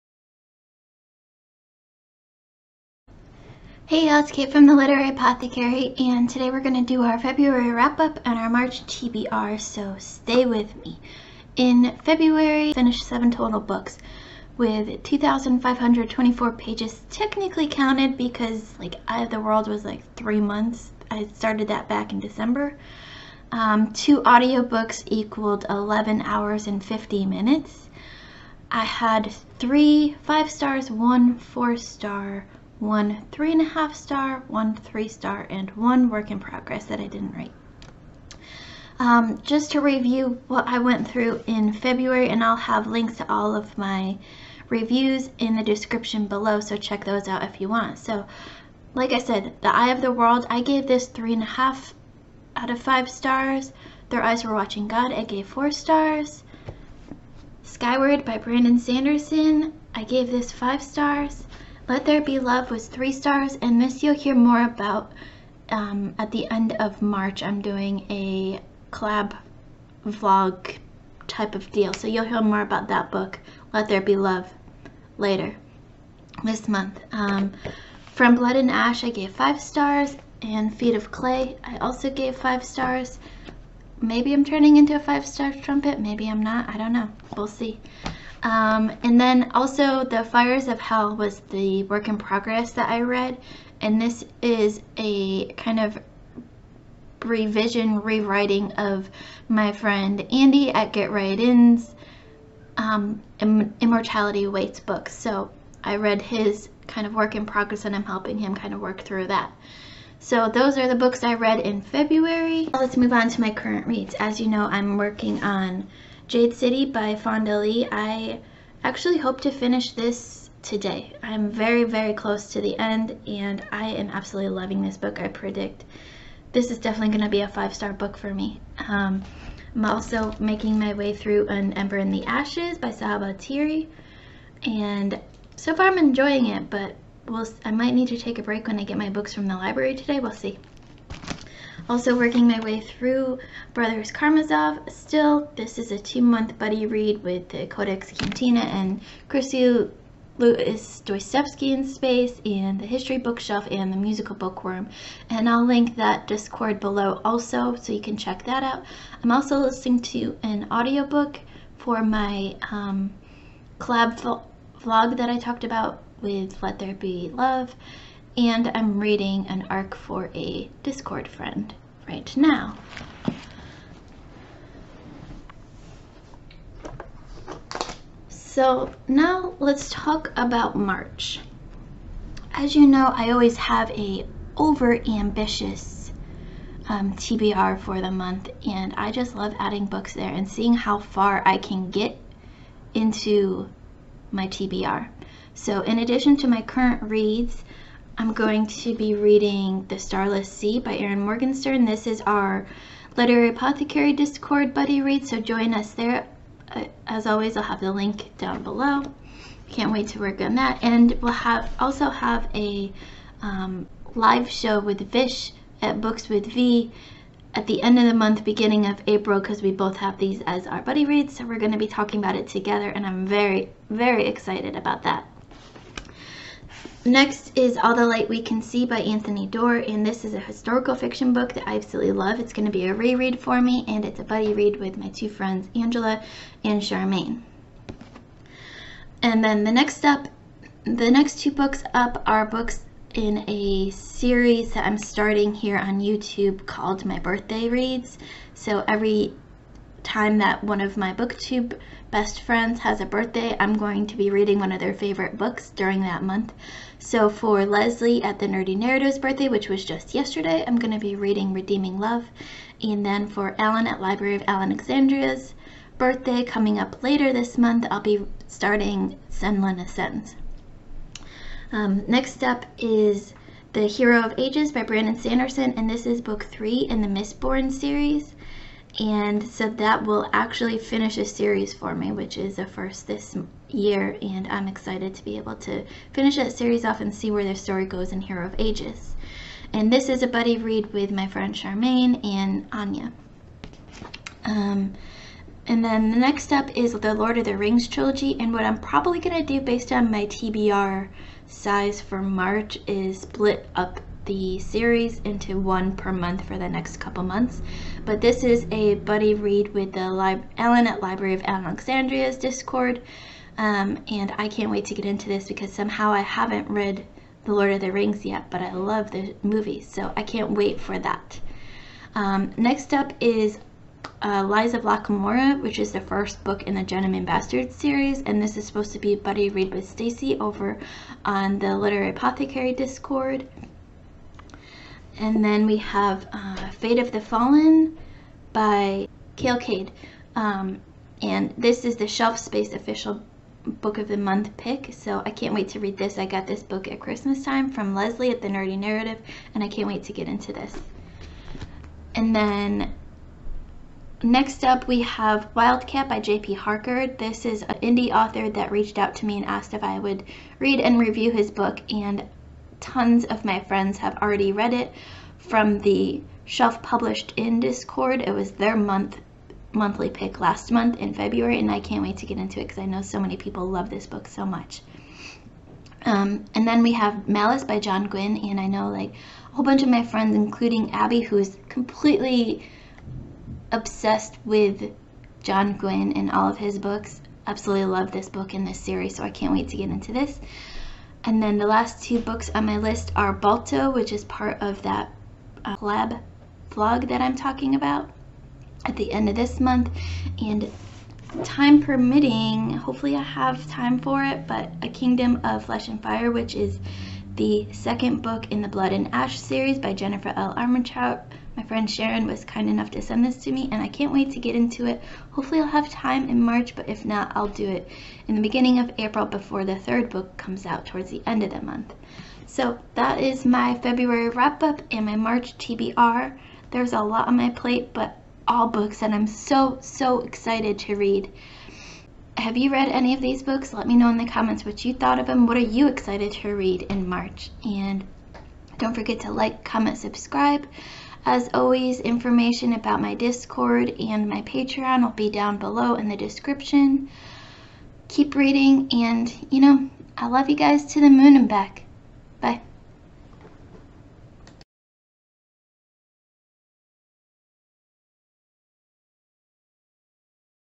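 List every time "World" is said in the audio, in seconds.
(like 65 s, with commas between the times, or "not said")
19 s, 50 s.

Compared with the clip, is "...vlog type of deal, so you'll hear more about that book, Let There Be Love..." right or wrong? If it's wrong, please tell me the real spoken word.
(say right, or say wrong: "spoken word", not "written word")
right.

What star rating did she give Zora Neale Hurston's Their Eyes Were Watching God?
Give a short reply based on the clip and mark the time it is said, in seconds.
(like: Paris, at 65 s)
4 stars, at 55 s.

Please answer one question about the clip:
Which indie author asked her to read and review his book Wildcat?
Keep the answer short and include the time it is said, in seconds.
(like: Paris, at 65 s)
J.P. Harker, at 356 s.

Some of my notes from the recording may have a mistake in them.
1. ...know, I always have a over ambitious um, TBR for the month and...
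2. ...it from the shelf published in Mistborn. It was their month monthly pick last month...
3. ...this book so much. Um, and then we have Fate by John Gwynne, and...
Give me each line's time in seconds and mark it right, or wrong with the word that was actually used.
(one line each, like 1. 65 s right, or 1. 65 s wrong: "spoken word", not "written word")
1. 182 s right
2. 364 s wrong: "Discord", not "Mistborn"
3. 373 s wrong: "Malice", not "Fate".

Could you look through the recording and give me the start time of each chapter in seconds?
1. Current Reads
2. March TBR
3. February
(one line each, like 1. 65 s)
1. 115 s
2. 180 s
3. 13 s.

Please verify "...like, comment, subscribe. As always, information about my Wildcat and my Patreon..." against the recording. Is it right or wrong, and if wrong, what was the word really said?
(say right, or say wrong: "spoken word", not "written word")
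wrong: "Discord", not "Wildcat".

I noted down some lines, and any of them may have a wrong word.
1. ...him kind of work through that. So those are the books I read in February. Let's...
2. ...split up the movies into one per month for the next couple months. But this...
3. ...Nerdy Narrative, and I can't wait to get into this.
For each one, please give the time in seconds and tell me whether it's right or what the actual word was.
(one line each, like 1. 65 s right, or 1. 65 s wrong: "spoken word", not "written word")
1. 108 s right
2. 303 s wrong: "series", not "movies"
3. 348 s right.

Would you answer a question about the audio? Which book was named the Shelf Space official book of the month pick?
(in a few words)
Fate of the Fallen.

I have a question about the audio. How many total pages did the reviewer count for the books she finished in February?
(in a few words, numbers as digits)
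2,524.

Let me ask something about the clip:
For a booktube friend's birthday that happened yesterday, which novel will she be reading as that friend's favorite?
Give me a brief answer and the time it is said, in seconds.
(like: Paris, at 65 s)
Redeeming Love, at 261 s.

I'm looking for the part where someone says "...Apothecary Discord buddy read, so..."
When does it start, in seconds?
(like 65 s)
203 s.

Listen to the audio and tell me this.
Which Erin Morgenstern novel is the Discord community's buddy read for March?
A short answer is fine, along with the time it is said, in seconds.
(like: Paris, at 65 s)
The Starless Sea, at 199 s.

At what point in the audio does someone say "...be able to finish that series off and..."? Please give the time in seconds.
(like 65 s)
285 s.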